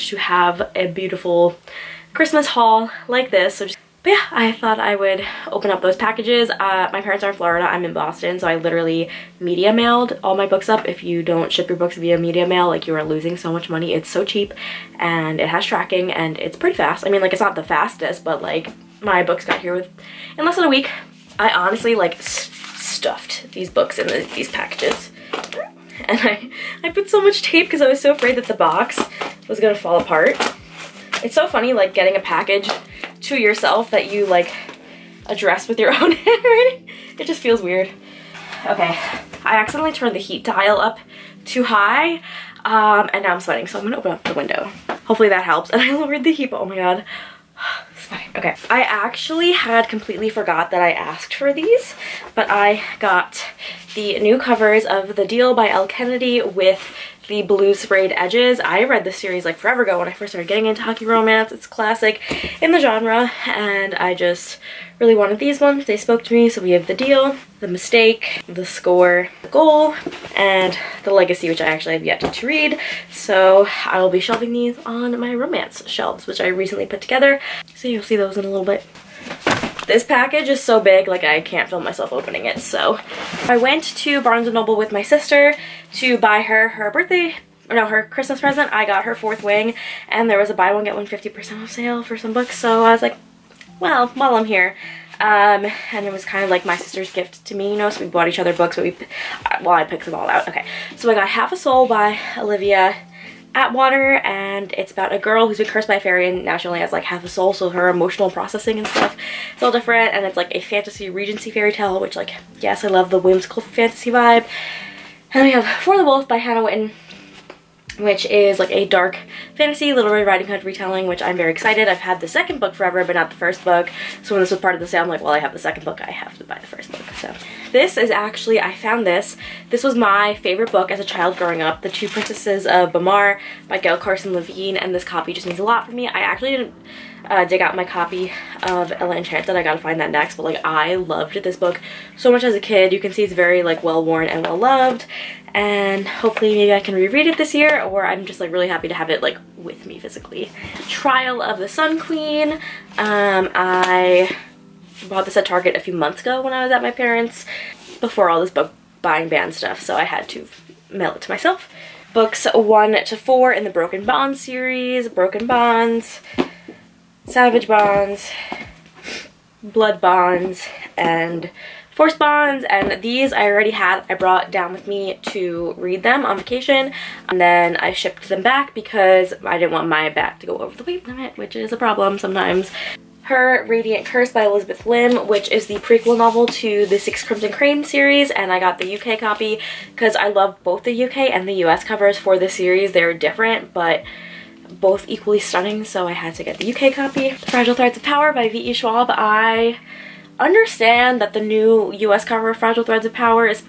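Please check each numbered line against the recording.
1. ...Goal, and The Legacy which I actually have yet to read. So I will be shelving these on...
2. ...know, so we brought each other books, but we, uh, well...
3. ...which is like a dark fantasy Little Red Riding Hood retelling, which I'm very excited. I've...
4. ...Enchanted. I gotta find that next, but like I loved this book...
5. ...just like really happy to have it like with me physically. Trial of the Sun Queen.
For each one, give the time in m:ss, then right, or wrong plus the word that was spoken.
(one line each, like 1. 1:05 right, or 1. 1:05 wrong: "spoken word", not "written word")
1. 1:09 right
2. 1:37 wrong: "bought", not "brought"
3. 1:57 right
4. 2:19 right
5. 2:28 right.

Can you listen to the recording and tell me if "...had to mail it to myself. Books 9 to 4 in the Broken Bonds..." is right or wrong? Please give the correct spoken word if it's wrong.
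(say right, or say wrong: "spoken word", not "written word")
wrong: "1", not "9".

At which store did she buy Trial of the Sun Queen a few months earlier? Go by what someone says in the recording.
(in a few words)
Target.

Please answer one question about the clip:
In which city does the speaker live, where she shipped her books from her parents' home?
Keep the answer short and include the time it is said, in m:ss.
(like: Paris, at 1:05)
Boston, at 0:07.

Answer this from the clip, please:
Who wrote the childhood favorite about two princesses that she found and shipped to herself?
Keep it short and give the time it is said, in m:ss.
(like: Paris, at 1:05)
Gail Carson Levine, at 2:13.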